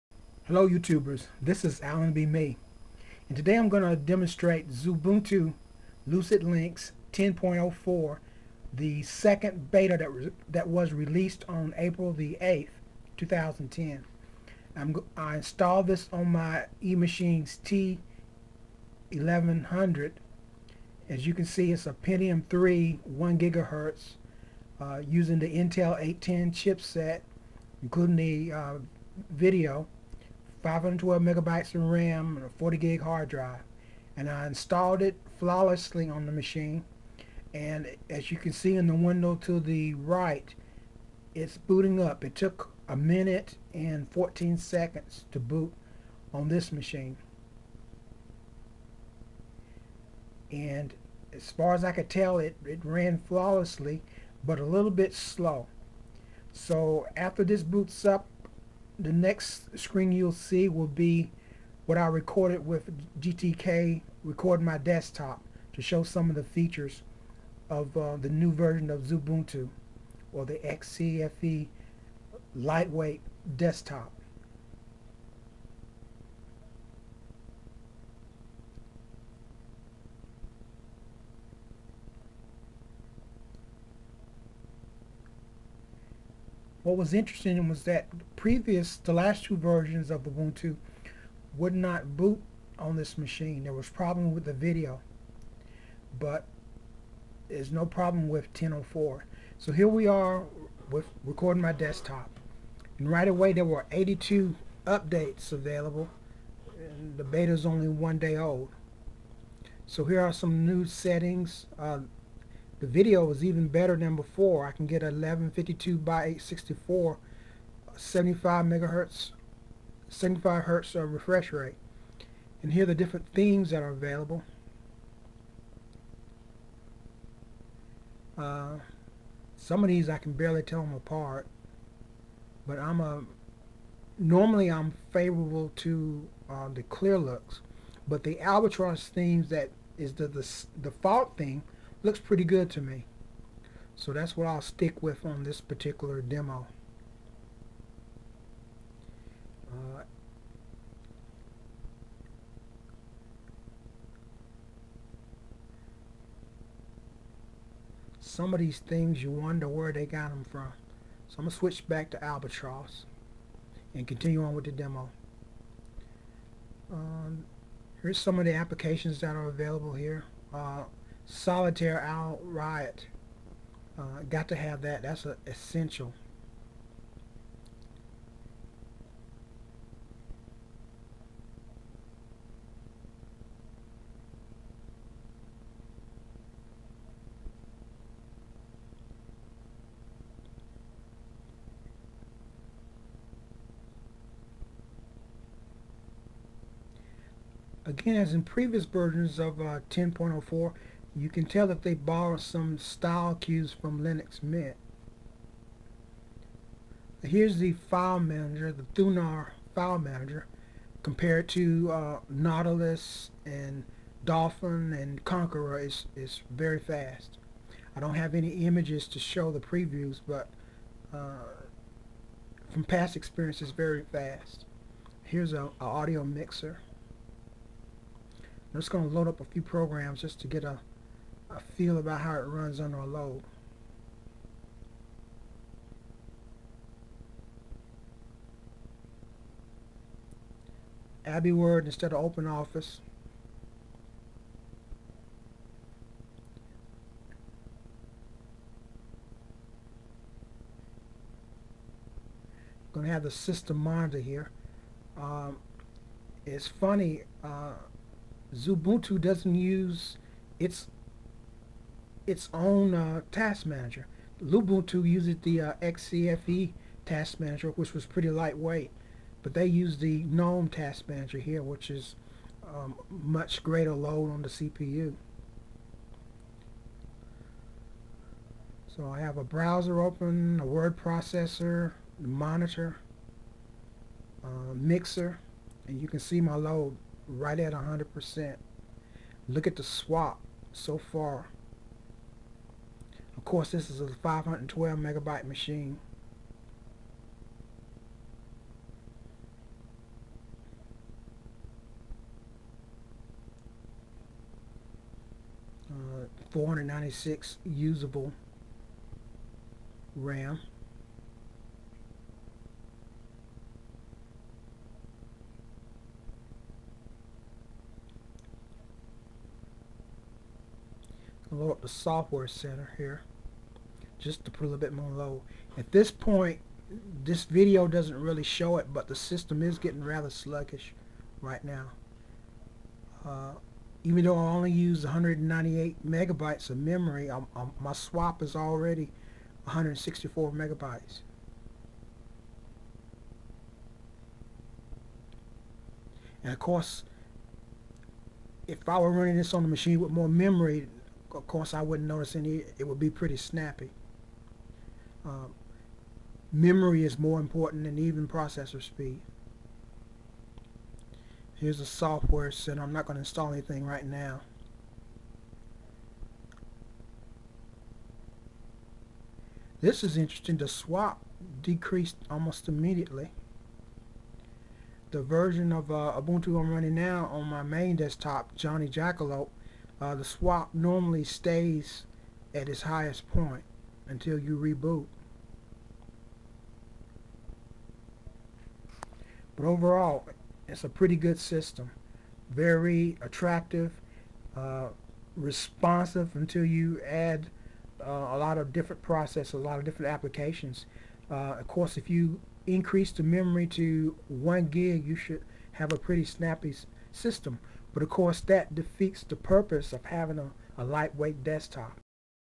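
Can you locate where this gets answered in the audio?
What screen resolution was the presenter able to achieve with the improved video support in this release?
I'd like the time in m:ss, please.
1:55.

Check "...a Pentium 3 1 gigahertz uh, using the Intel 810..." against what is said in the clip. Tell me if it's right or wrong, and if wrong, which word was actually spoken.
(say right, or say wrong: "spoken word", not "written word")
right.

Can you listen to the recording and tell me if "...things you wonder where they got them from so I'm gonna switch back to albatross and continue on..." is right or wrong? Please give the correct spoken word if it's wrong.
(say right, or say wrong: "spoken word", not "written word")
right.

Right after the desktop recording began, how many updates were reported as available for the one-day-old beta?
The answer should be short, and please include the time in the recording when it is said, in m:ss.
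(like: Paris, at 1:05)
82, at 1:43.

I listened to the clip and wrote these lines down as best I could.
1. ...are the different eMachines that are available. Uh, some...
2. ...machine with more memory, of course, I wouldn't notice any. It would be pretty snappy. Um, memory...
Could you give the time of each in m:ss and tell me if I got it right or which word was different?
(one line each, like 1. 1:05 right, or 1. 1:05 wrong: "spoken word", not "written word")
1. 2:02 wrong: "themes", not "eMachines"
2. 5:49 right.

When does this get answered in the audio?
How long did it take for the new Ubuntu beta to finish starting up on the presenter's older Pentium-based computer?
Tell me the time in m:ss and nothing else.
0:42.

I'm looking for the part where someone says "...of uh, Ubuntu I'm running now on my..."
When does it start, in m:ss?
6:15.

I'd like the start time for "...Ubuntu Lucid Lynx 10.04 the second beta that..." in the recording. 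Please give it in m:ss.
0:04.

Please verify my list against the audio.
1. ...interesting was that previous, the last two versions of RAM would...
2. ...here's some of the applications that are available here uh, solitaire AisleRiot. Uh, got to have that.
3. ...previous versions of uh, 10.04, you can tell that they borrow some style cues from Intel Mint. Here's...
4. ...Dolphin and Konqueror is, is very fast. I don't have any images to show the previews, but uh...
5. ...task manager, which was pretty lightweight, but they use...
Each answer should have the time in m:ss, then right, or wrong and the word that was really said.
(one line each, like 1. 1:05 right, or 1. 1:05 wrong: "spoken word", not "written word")
1. 1:27 wrong: "Ubuntu", not "RAM"
2. 2:48 right
3. 3:18 wrong: "Linux", not "Intel"
4. 3:34 right
5. 4:27 right.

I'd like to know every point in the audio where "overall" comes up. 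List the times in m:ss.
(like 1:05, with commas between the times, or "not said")
6:29.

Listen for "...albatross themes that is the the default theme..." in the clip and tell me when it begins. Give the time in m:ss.
2:18.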